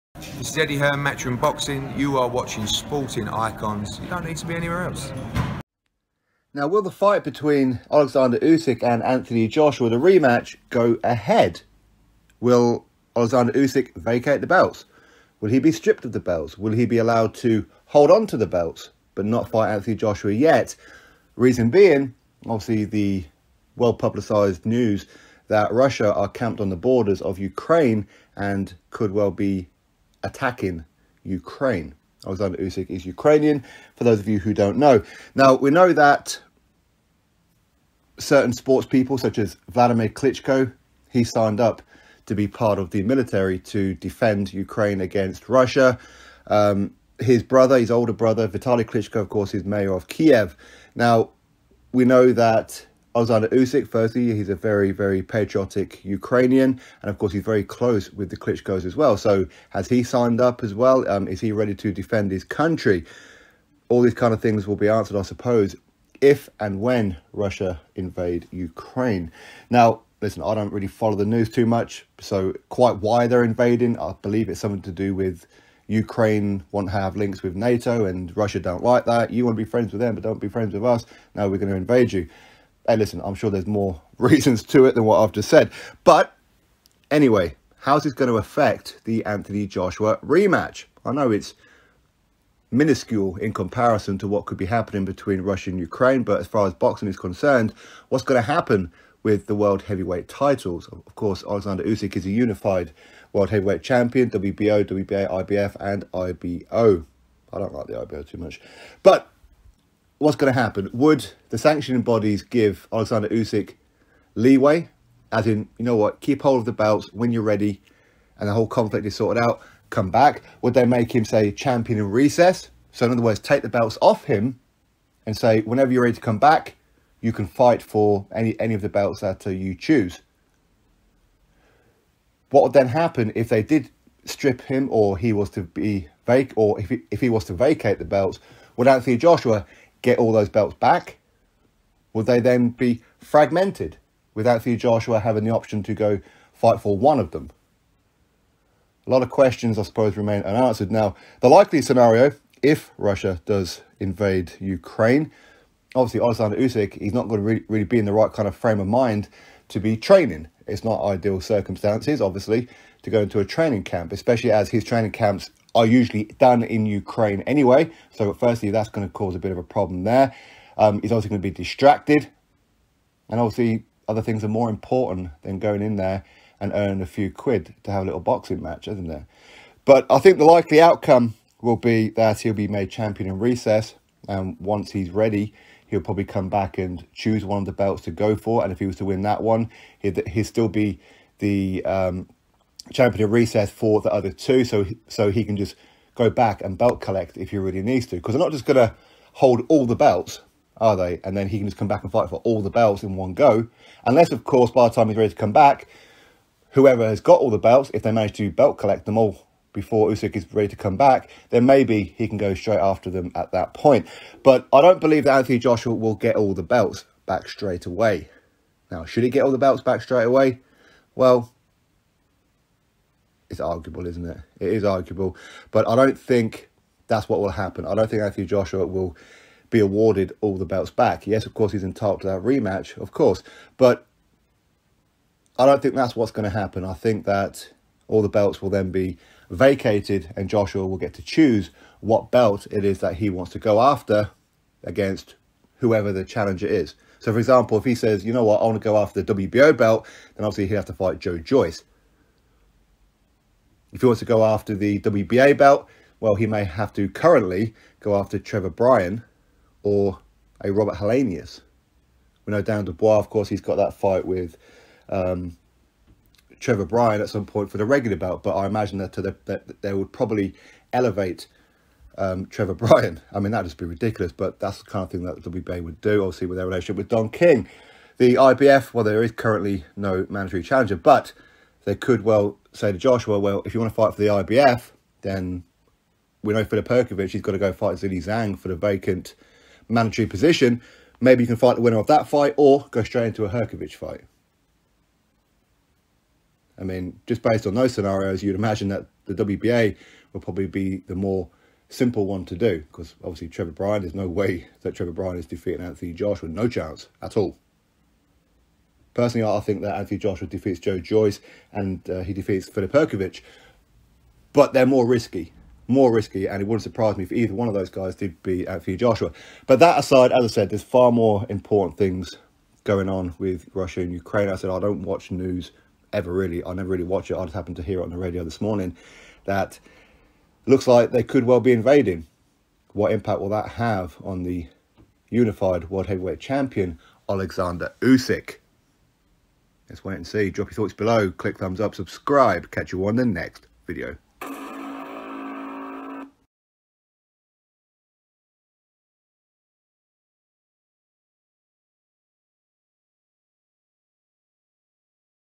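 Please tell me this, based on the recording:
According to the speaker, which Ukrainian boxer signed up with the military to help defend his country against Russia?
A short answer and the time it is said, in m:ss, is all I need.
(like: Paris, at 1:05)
Vladimir Klitschko, at 0:39.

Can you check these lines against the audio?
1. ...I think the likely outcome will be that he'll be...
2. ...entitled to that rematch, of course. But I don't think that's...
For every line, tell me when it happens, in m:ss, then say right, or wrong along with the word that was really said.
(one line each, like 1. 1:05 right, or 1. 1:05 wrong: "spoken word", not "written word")
1. 3:00 right
2. 3:51 right.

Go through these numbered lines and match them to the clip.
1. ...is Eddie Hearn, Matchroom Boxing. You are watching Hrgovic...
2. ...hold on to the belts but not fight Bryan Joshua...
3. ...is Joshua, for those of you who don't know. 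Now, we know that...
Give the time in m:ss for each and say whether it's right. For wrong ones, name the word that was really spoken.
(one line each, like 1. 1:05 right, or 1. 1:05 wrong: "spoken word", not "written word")
1. 0:00 wrong: "Sporting", not "Hrgovic"
2. 0:17 wrong: "Anthony", not "Bryan"
3. 0:32 wrong: "Ukrainian", not "Joshua".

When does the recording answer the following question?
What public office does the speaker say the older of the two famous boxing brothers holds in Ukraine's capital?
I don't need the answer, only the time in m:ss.
0:49.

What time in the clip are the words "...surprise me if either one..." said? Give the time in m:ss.
5:16.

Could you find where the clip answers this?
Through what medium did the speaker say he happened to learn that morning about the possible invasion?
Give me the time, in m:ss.
5:28.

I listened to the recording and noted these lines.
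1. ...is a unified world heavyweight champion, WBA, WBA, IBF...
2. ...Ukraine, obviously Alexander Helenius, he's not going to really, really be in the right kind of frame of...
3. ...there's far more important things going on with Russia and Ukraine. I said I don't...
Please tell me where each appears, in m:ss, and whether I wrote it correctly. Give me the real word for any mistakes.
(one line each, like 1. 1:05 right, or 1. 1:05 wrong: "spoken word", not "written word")
1. 1:42 wrong: "WBO", not "WBA"
2. 2:34 wrong: "Usyk", not "Helenius"
3. 5:20 right.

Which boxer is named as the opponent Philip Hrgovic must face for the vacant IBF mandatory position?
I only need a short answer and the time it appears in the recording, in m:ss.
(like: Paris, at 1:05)
Zhilei Zhang, at 4:47.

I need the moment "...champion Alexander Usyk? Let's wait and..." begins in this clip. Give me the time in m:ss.
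5:36.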